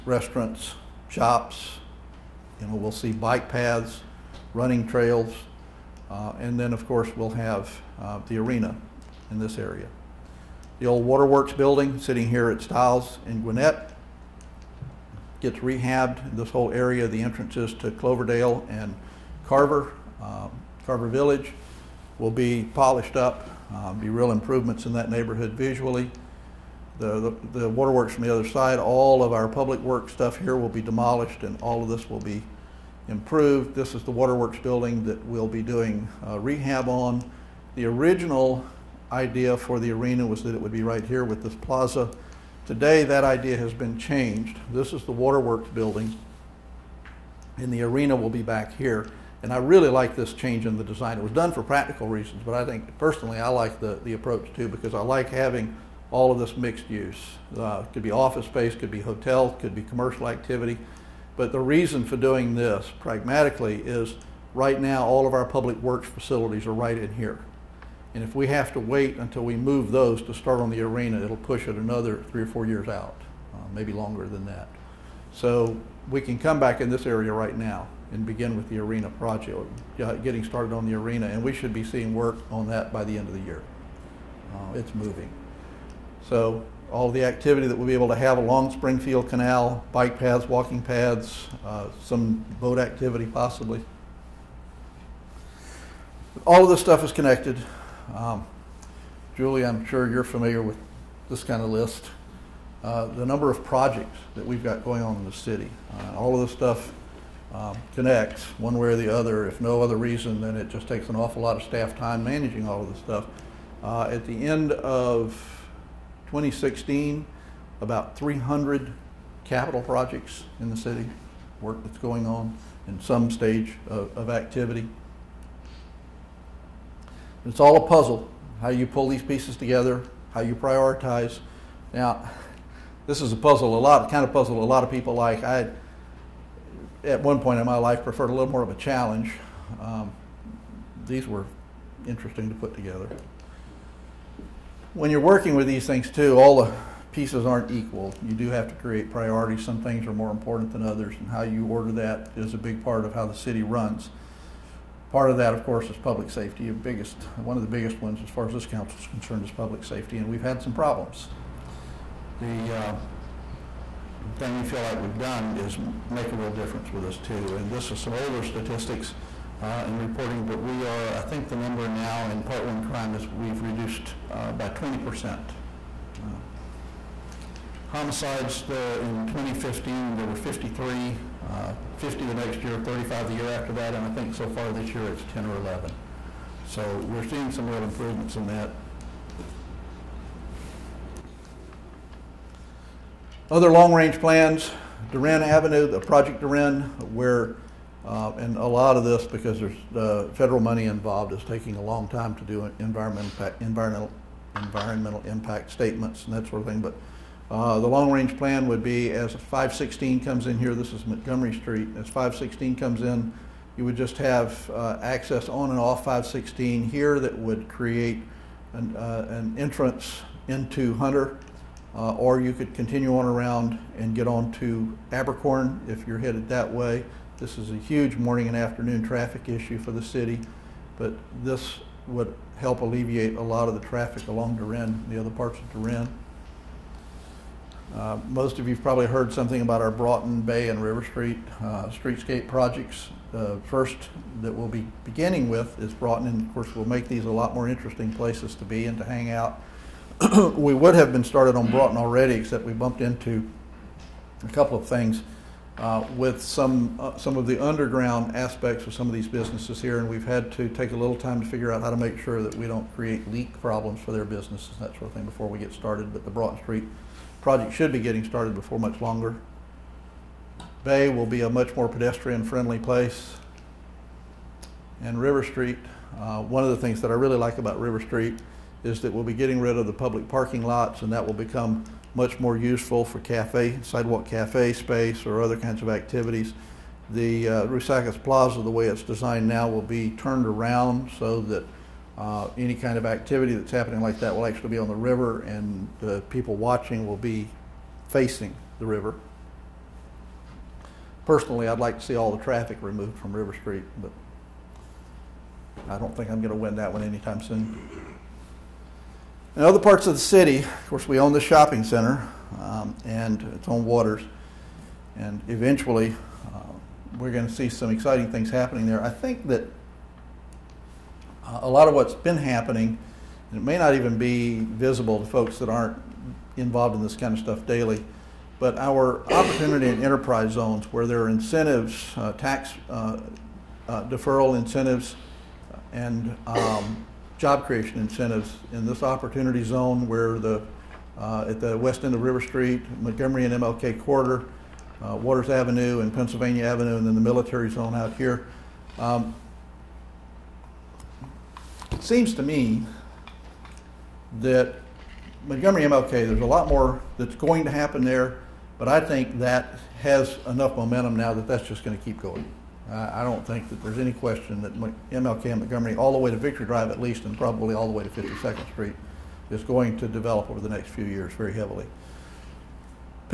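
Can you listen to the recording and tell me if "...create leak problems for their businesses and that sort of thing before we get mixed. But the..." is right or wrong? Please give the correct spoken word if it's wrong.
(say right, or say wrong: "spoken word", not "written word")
wrong: "started", not "mixed".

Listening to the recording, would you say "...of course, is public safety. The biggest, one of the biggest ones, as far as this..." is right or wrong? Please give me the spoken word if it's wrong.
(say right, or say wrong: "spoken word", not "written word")
right.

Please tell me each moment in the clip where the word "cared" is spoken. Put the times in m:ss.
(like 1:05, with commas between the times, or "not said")
not said.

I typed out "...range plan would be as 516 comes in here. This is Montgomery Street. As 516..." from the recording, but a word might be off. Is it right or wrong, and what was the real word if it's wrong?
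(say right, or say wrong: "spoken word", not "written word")
right.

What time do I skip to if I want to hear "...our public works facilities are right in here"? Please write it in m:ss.
1:05.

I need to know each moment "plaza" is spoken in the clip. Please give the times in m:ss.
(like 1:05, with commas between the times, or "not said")
0:41, 4:48.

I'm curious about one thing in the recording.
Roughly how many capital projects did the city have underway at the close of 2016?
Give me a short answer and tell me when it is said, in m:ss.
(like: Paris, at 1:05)
300, at 1:58.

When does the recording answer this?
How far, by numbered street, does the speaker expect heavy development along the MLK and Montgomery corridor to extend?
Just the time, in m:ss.
6:08.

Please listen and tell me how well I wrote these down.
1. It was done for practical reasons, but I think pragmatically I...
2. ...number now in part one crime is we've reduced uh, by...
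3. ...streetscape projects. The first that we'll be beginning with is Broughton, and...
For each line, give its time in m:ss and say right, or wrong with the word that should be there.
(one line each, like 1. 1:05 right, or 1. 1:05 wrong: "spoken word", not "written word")
1. 0:51 wrong: "personally", not "pragmatically"
2. 2:51 right
3. 4:01 right.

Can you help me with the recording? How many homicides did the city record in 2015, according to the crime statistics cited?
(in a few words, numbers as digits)
53.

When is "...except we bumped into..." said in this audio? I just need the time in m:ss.
4:12.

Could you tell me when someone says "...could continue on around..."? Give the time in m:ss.
3:42.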